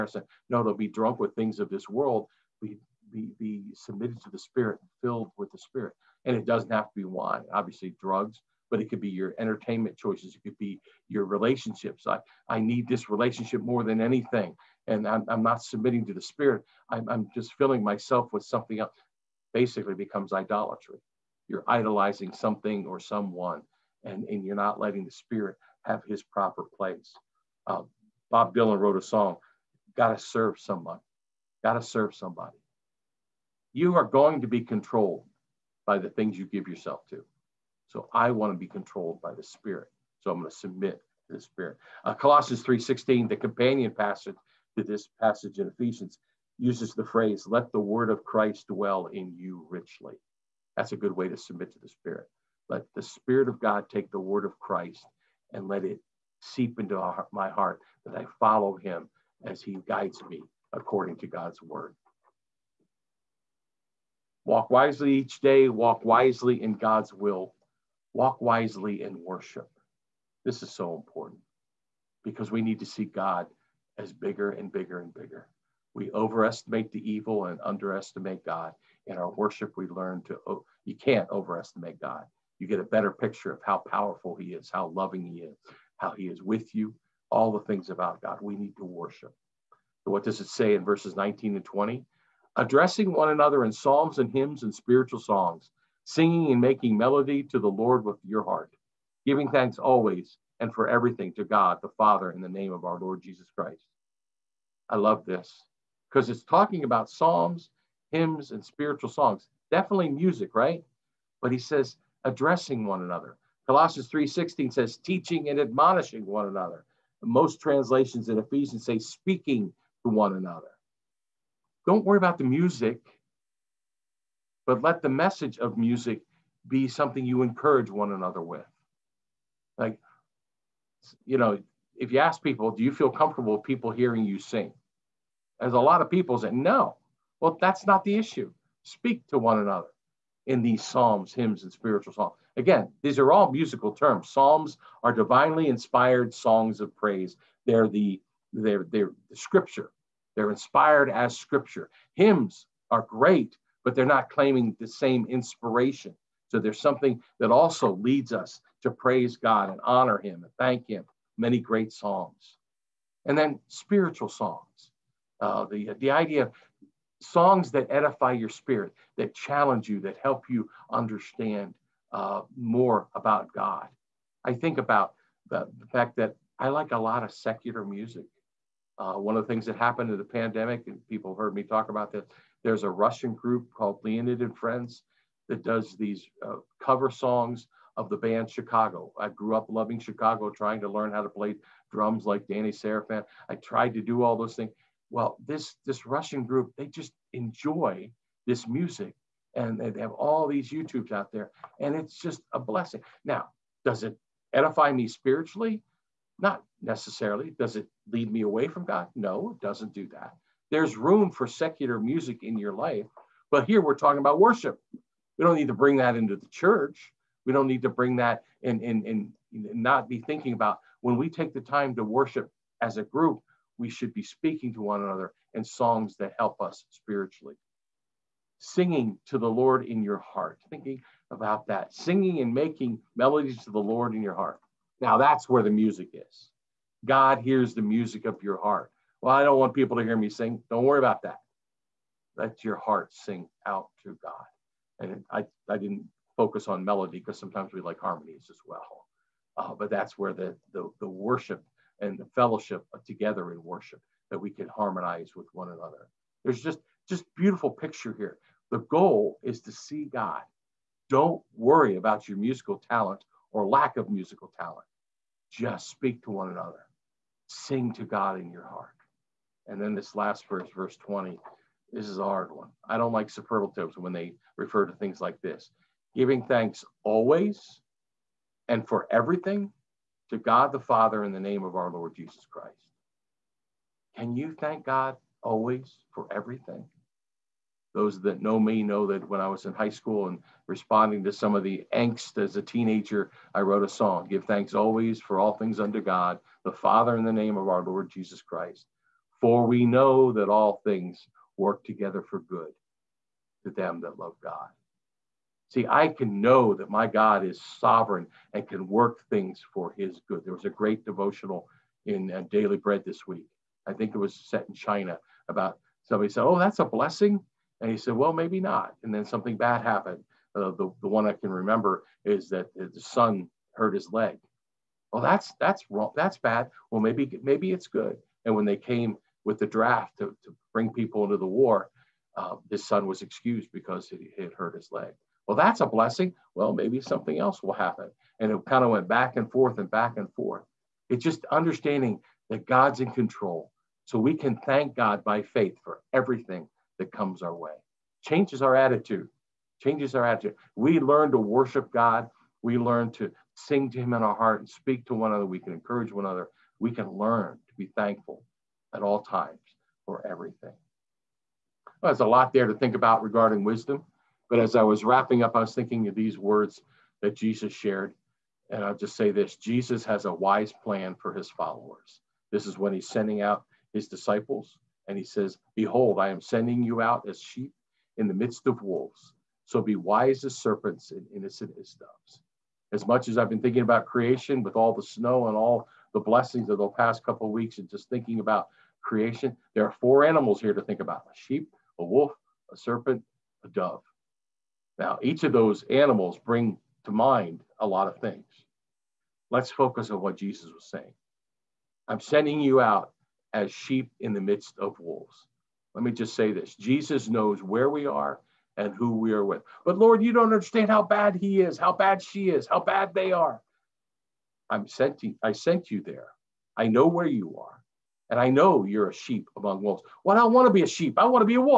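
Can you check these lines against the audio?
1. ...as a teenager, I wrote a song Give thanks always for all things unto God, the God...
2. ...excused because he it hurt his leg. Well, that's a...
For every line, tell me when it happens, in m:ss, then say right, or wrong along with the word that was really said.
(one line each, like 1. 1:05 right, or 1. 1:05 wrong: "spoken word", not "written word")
1. 4:52 wrong: "Father", not "God"
2. 5:33 right.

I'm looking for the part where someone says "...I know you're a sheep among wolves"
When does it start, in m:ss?
6:58.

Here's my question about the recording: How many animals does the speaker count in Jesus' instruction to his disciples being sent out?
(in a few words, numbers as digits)
4.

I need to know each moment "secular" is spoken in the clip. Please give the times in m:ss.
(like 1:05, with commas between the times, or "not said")
2:57, 3:31.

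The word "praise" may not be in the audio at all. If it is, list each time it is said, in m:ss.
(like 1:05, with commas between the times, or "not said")
2:26, 2:38.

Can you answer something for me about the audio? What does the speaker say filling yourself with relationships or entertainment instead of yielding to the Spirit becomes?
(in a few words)
idolatry.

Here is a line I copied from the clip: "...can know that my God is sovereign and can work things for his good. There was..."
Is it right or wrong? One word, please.
right.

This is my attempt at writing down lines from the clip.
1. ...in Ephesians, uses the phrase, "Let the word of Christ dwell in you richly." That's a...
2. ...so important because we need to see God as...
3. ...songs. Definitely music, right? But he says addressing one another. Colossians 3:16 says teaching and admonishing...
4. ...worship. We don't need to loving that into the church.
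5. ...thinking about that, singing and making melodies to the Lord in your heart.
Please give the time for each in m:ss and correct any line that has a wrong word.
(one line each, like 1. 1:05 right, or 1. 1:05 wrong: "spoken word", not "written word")
1. 0:45 right
2. 1:10 right
3. 1:49 right
4. 3:34 wrong: "bring", not "loving"
5. 3:50 right.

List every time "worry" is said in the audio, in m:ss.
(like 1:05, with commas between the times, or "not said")
2:02, 4:00, 4:21.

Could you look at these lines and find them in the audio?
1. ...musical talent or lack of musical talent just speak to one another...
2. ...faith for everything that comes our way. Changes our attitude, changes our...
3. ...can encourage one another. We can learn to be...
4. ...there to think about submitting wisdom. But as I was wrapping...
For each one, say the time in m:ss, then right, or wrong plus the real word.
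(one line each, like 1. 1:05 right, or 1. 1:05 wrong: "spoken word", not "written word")
1. 4:22 right
2. 5:45 right
3. 5:55 right
4. 6:02 wrong: "regarding", not "submitting".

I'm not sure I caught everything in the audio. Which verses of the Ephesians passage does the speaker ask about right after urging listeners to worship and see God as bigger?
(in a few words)
19 and 20.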